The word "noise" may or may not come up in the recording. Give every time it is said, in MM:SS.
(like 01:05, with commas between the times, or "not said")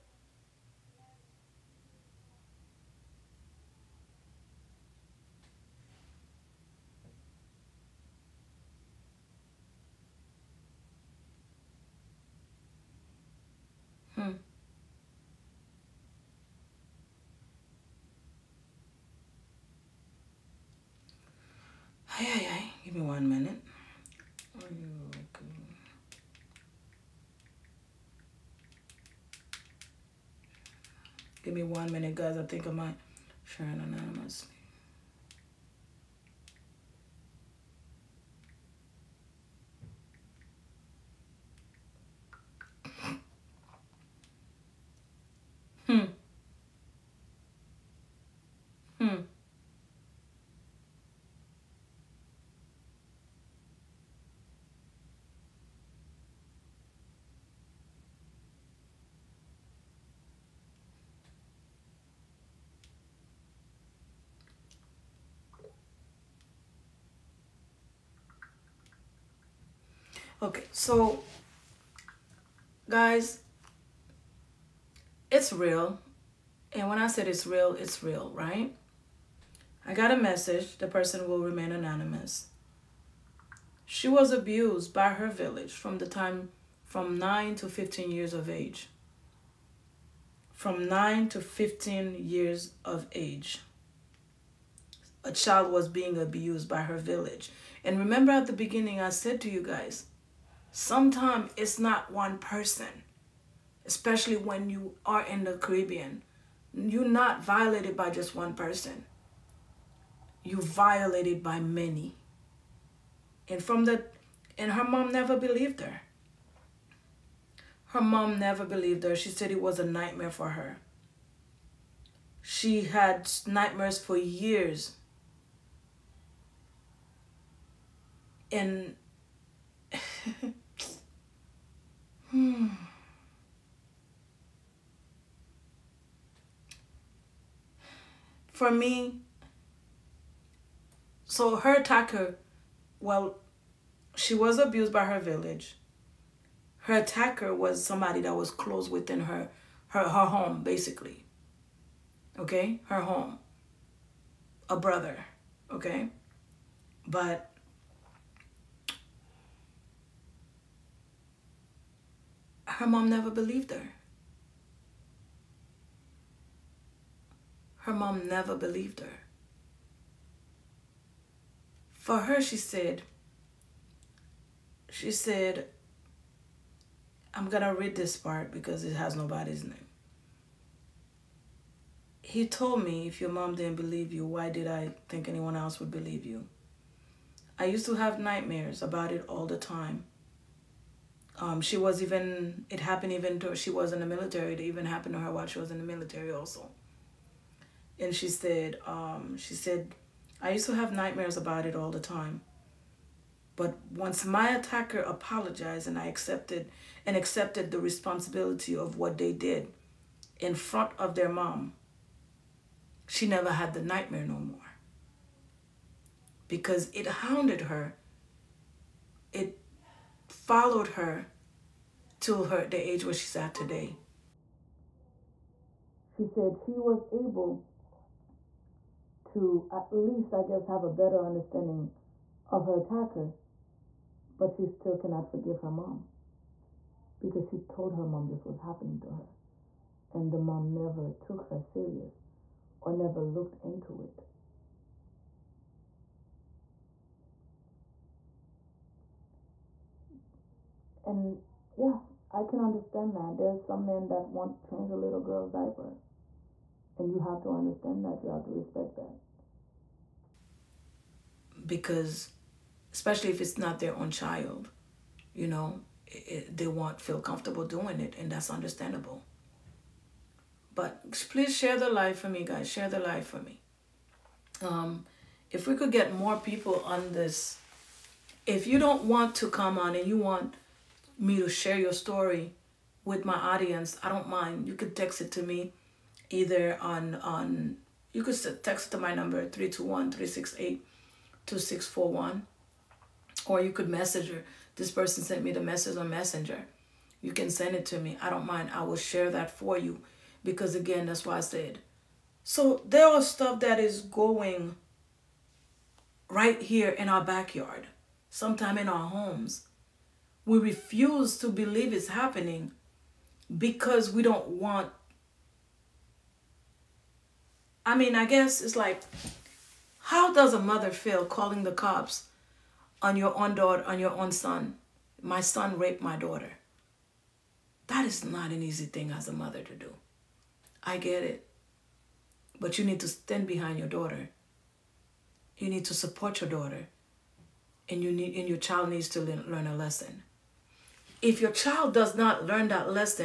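not said.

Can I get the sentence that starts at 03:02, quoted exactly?
He told me, if your mom didn't believe you, why did I think anyone else would believe you?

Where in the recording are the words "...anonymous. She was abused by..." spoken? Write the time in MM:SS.
01:21.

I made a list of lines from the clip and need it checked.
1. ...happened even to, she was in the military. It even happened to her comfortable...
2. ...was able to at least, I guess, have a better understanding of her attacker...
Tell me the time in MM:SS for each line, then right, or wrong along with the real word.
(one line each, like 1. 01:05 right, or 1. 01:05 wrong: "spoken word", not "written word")
1. 03:12 wrong: "while", not "comfortable"
2. 03:46 right.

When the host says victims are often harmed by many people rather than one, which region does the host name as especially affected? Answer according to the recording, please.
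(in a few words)
The Caribbean.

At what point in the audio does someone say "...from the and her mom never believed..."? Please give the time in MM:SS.
01:53.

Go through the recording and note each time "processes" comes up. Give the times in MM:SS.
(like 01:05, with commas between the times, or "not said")
not said.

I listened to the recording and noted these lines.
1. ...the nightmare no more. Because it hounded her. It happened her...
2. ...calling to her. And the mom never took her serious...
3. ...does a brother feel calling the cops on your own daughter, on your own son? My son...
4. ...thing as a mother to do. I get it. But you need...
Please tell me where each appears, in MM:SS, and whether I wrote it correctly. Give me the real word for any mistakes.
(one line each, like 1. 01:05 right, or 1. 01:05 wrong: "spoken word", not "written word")
1. 03:33 wrong: "followed", not "happened"
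2. 03:58 wrong: "happening", not "calling"
3. 05:20 wrong: "mother", not "brother"
4. 05:28 right.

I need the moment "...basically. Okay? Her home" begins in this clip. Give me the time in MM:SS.
02:30.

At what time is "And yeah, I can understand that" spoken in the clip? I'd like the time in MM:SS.
04:11.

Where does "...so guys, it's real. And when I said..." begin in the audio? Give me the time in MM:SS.
01:10.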